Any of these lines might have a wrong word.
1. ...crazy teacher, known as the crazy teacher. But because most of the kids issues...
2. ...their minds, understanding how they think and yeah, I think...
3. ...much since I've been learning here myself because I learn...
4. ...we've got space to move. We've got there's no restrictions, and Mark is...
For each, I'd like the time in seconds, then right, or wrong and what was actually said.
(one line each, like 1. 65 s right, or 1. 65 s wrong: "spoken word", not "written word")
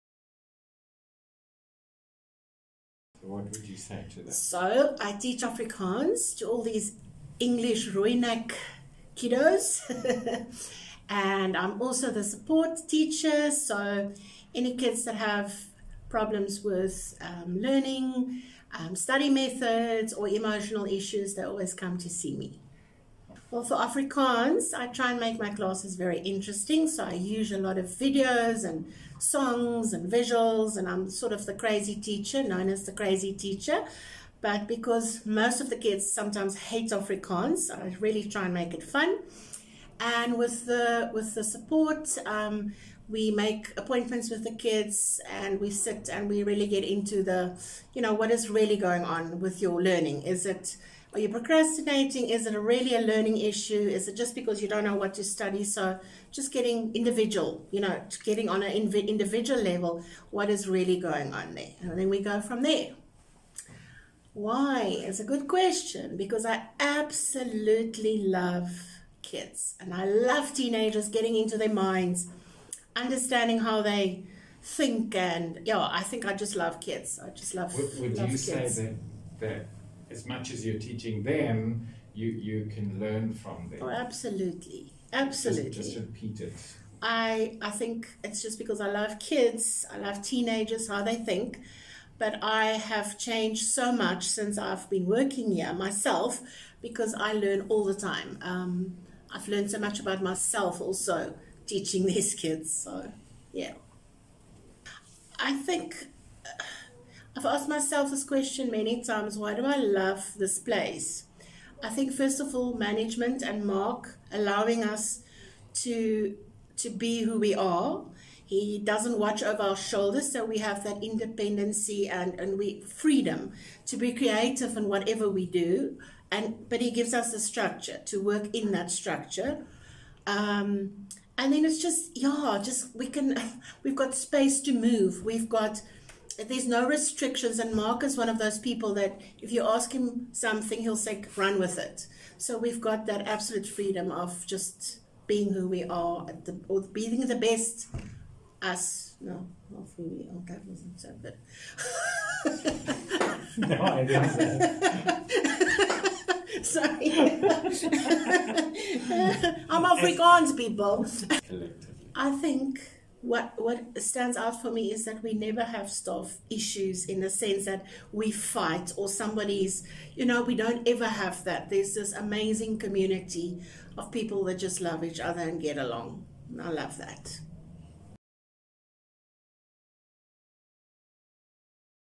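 1. 31 s wrong: "sometimes", not "issues"
2. 71 s right
3. 93 s wrong: "working", not "learning"
4. 133 s right.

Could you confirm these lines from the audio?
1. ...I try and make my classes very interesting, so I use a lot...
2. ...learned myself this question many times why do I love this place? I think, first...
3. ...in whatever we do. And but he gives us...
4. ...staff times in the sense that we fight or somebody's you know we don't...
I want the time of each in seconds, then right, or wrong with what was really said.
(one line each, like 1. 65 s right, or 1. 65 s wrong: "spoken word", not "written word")
1. 24 s right
2. 107 s wrong: "asked", not "learned"
3. 124 s right
4. 165 s wrong: "issues", not "times".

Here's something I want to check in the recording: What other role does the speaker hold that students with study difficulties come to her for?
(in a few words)
support teacher.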